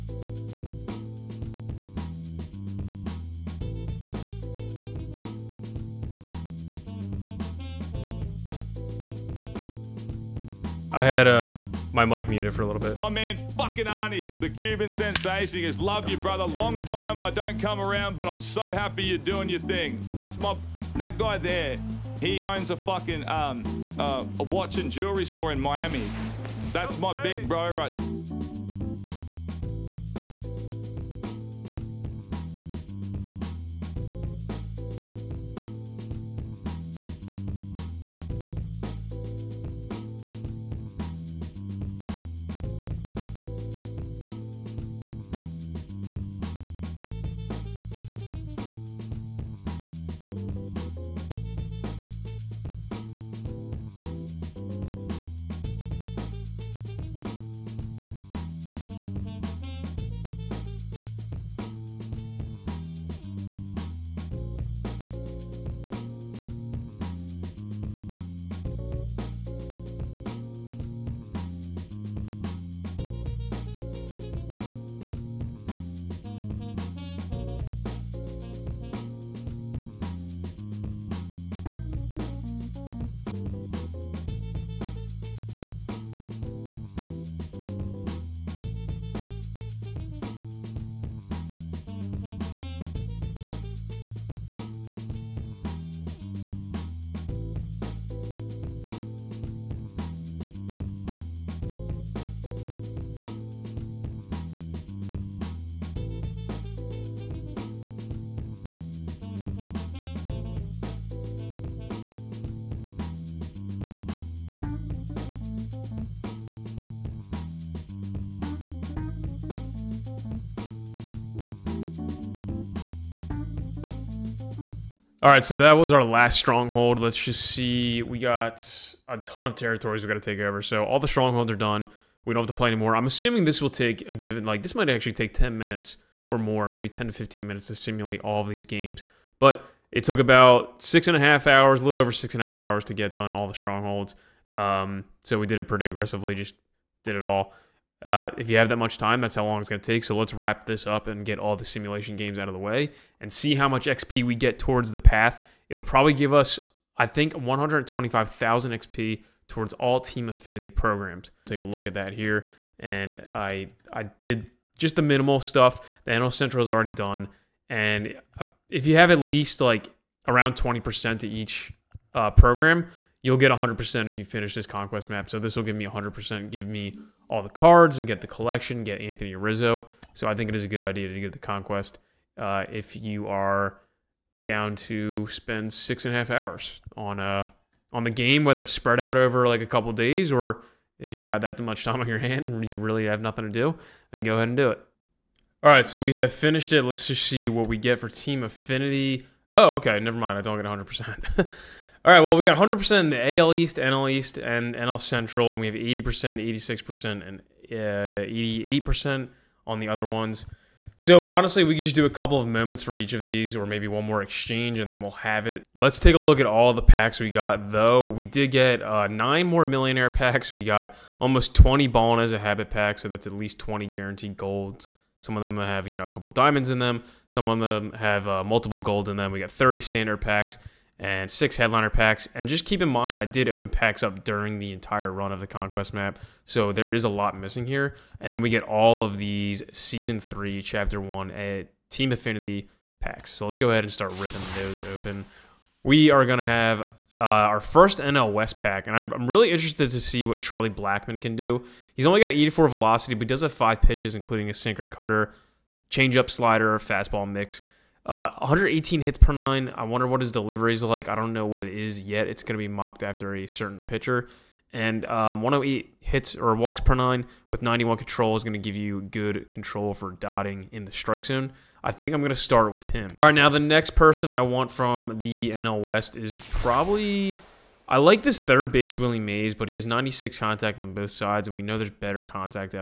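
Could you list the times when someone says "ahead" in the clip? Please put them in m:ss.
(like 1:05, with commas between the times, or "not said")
3:14, 4:03.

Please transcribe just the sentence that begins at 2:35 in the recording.
It'll probably give us, I think, 125,000 XP towards all team affinity programs.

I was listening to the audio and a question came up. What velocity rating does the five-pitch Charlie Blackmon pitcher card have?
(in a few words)
84.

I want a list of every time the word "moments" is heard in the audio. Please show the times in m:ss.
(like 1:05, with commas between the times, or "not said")
3:32.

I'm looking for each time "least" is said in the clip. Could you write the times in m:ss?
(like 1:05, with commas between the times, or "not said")
2:49, 3:43.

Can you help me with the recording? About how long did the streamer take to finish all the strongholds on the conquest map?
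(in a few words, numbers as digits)
6 and a half hours.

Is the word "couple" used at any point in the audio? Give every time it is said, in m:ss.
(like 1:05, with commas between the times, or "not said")
3:09, 3:32, 3:46.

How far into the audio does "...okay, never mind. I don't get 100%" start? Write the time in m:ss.
3:19.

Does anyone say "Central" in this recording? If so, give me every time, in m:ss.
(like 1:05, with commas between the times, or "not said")
2:46, 3:25.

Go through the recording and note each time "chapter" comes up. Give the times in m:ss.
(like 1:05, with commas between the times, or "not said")
4:00.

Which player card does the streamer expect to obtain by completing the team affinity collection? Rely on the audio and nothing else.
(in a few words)
Anthony Rizzo.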